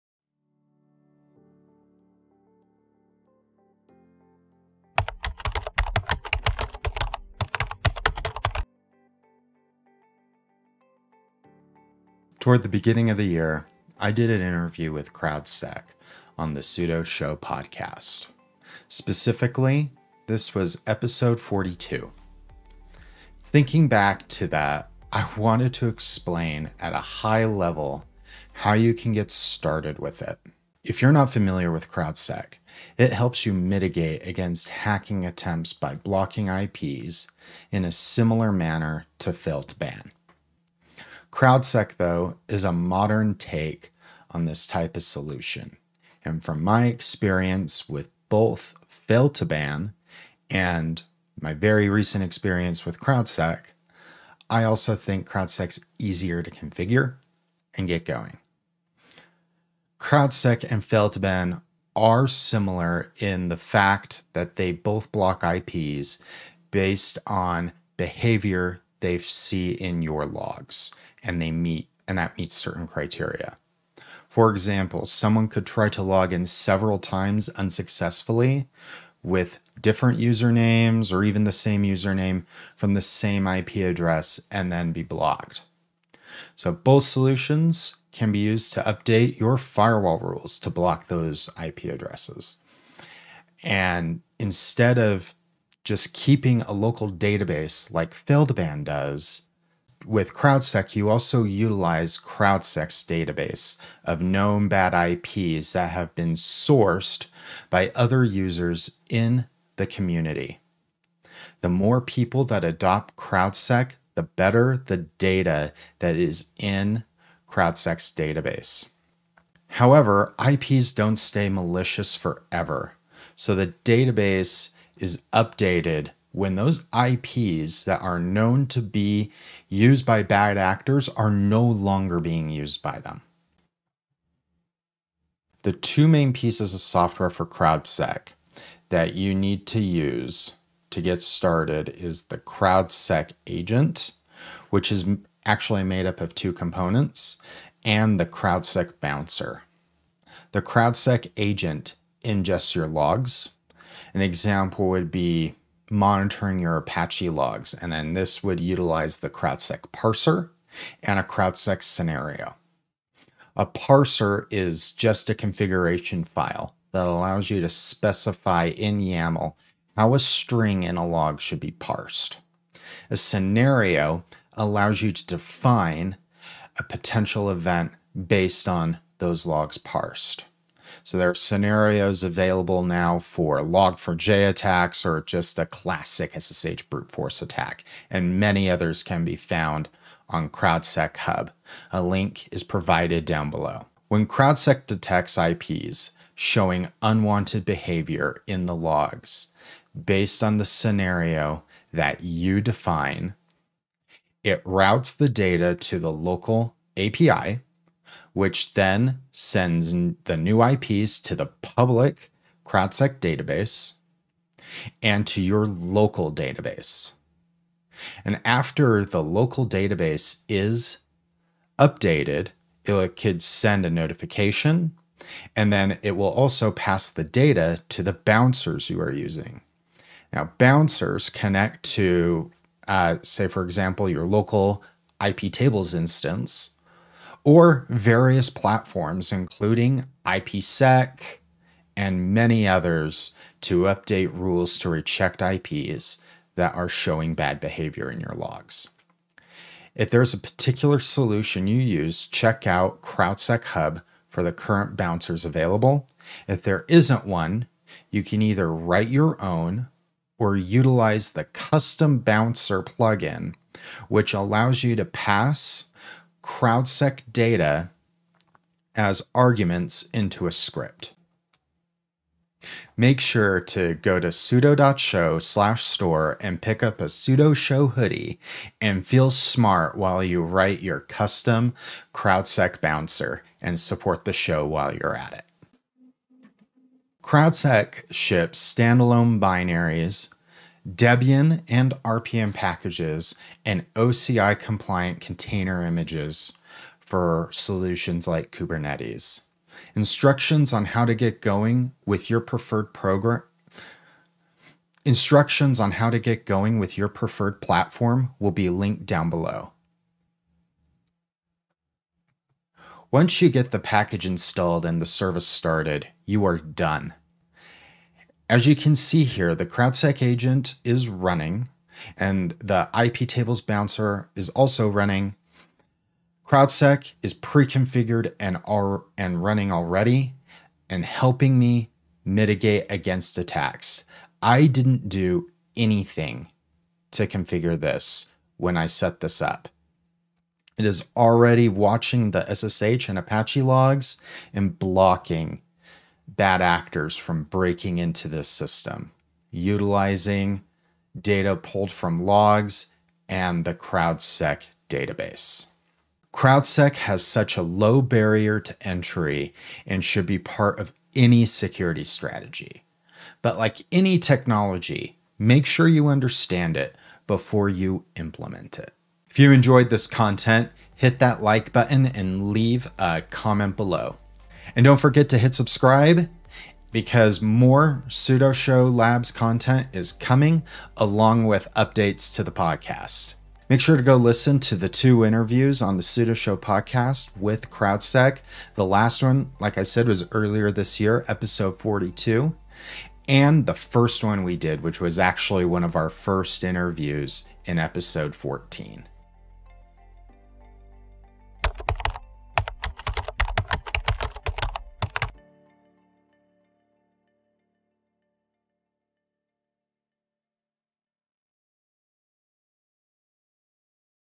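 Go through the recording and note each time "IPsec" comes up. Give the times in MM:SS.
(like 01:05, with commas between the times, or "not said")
04:00.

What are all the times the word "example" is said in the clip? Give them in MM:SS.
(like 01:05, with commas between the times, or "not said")
01:14, 02:34, 03:53.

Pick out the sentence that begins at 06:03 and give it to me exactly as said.
But like any technology, make sure you understand it before you implement it.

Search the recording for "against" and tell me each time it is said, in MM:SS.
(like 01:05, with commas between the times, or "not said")
00:34, 05:32.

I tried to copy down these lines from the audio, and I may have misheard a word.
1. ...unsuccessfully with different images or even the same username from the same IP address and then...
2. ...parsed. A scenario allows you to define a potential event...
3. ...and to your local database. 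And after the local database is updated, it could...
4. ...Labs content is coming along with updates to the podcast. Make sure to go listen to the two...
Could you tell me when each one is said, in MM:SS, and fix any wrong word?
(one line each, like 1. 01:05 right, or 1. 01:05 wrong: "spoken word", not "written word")
1. 01:17 wrong: "usernames", not "images"
2. 02:51 right
3. 03:35 right
4. 06:18 right.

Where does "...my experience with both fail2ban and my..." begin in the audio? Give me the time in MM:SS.
00:46.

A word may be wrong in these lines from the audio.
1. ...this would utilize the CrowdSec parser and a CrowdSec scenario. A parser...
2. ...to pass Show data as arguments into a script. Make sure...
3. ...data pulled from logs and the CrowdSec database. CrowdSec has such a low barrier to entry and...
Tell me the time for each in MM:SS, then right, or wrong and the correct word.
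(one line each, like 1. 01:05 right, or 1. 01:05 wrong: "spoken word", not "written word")
1. 02:38 right
2. 04:24 wrong: "CrowdSec", not "Show"
3. 05:51 right.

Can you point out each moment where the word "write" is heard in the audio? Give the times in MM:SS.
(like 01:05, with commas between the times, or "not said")
04:18, 04:40.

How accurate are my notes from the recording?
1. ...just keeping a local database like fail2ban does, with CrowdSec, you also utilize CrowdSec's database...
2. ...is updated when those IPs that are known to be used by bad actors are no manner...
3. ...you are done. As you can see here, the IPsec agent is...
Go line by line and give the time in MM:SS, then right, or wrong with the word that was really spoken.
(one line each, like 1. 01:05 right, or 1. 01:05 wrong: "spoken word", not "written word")
1. 01:35 right
2. 02:04 wrong: "longer", not "manner"
3. 05:16 wrong: "CrowdSec", not "IPsec".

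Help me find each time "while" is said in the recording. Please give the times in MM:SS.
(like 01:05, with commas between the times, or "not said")
04:39, 04:44.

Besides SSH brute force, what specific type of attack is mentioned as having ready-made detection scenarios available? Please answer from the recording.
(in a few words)
log4j.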